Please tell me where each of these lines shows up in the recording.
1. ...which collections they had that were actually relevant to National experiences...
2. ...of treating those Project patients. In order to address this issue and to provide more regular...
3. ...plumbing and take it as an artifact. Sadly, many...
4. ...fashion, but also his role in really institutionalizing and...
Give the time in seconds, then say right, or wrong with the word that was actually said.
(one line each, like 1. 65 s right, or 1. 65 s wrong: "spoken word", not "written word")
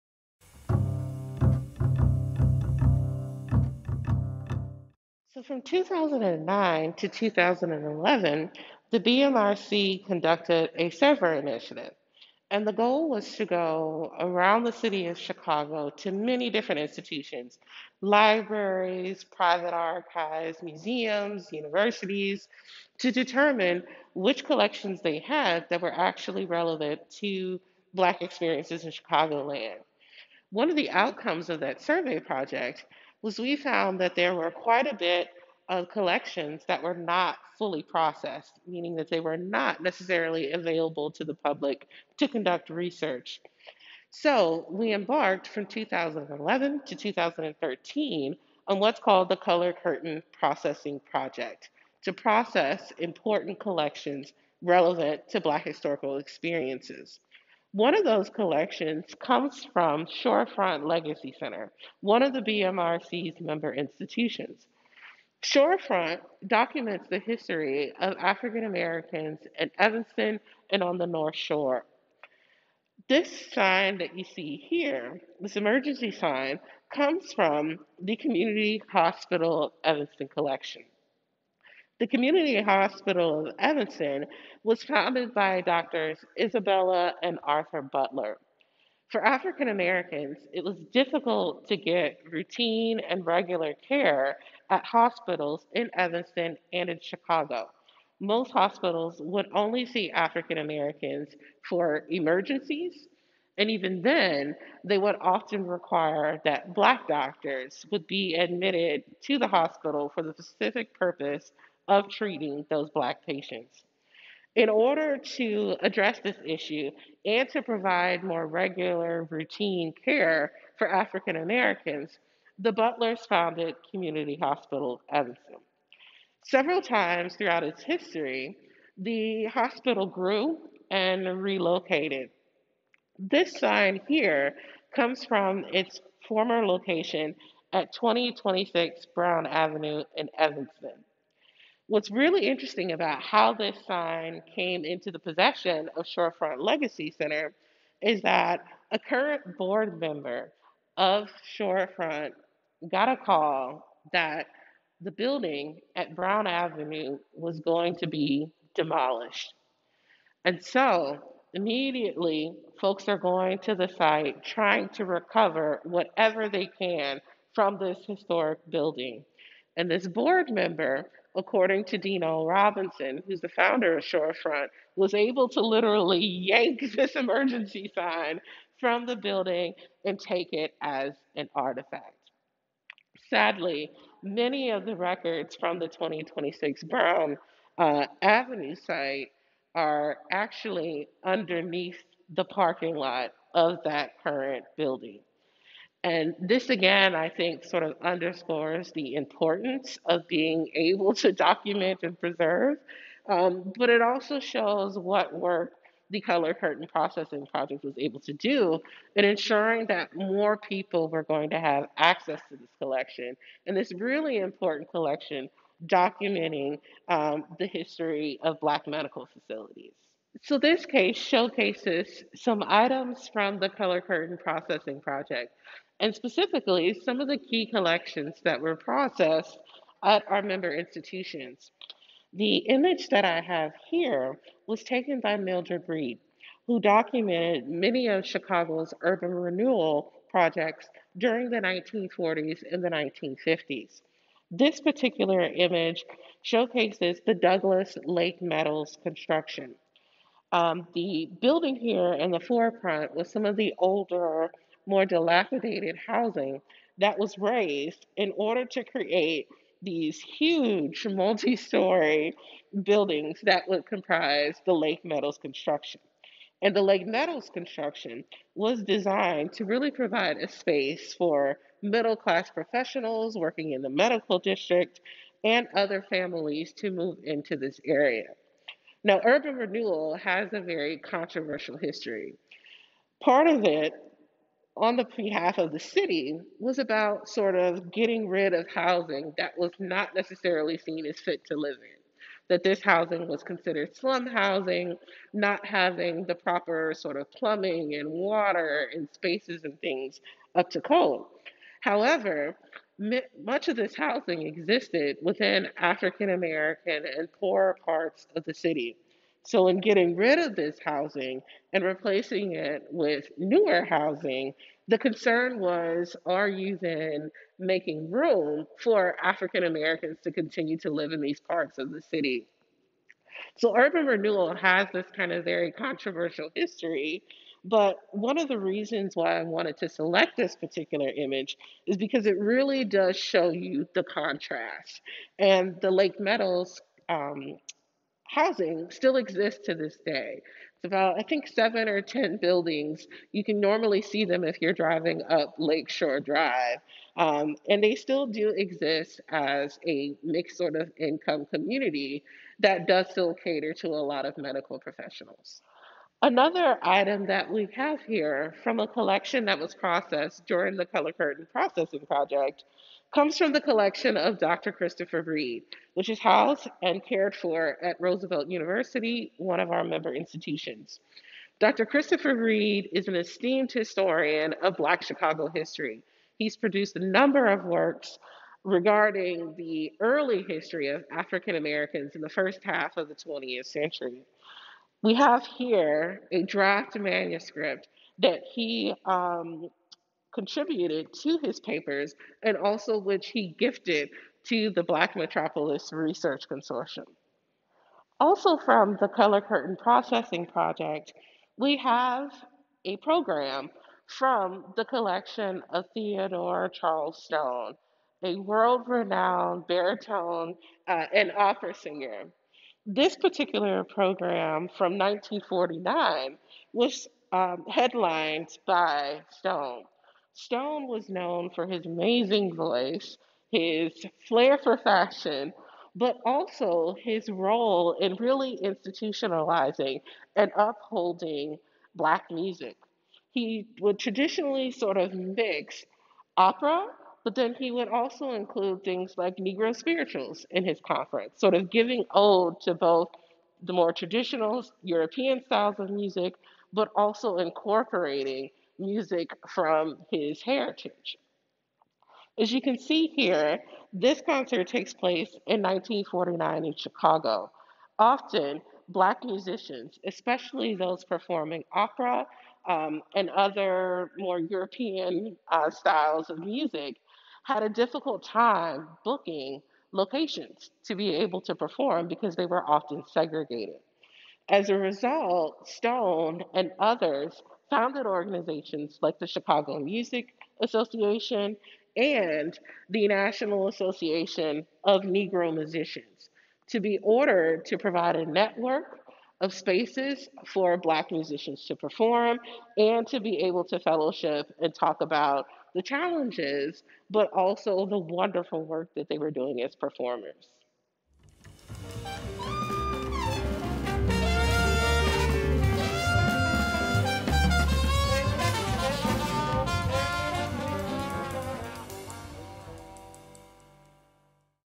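1. 24 s wrong: "Black", not "National"
2. 111 s wrong: "Black", not "Project"
3. 179 s wrong: "building", not "plumbing"
4. 424 s right.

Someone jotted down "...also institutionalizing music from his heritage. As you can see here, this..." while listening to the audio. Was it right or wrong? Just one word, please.
wrong.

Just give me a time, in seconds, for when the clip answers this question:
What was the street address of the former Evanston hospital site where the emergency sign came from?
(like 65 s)
137 s.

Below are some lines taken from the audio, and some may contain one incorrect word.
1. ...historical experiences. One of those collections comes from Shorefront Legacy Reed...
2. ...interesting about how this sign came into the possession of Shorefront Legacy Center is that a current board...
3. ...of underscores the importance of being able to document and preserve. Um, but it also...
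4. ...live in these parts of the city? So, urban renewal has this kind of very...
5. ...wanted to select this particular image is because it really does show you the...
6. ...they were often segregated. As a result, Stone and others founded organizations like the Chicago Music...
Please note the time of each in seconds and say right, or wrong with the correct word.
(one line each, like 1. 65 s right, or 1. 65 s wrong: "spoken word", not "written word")
1. 55 s wrong: "Center", not "Reed"
2. 142 s right
3. 197 s right
4. 320 s right
5. 329 s right
6. 472 s right.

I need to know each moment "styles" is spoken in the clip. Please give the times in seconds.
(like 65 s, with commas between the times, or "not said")
445 s, 465 s.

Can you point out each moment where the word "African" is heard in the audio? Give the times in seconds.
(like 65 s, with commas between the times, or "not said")
68 s, 89 s, 100 s, 120 s, 305 s, 319 s, 381 s.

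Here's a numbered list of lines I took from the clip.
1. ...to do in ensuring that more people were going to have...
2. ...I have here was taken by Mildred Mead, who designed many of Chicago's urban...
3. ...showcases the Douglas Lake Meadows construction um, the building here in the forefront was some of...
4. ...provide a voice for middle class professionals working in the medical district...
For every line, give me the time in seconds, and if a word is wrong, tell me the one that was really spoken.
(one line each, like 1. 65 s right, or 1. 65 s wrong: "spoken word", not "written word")
1. 208 s right
2. 233 s wrong: "documented", not "designed"
3. 246 s right
4. 269 s wrong: "space", not "voice".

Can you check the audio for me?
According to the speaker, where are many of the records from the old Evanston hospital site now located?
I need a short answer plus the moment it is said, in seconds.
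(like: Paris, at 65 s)
underneath the parking lot, at 191 s.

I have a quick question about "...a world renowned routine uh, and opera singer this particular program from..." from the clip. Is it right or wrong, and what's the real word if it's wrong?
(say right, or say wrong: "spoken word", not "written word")
wrong: "baritone", not "routine".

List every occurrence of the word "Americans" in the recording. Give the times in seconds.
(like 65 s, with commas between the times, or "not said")
68 s, 89 s, 100 s, 121 s, 306 s, 319 s, 381 s.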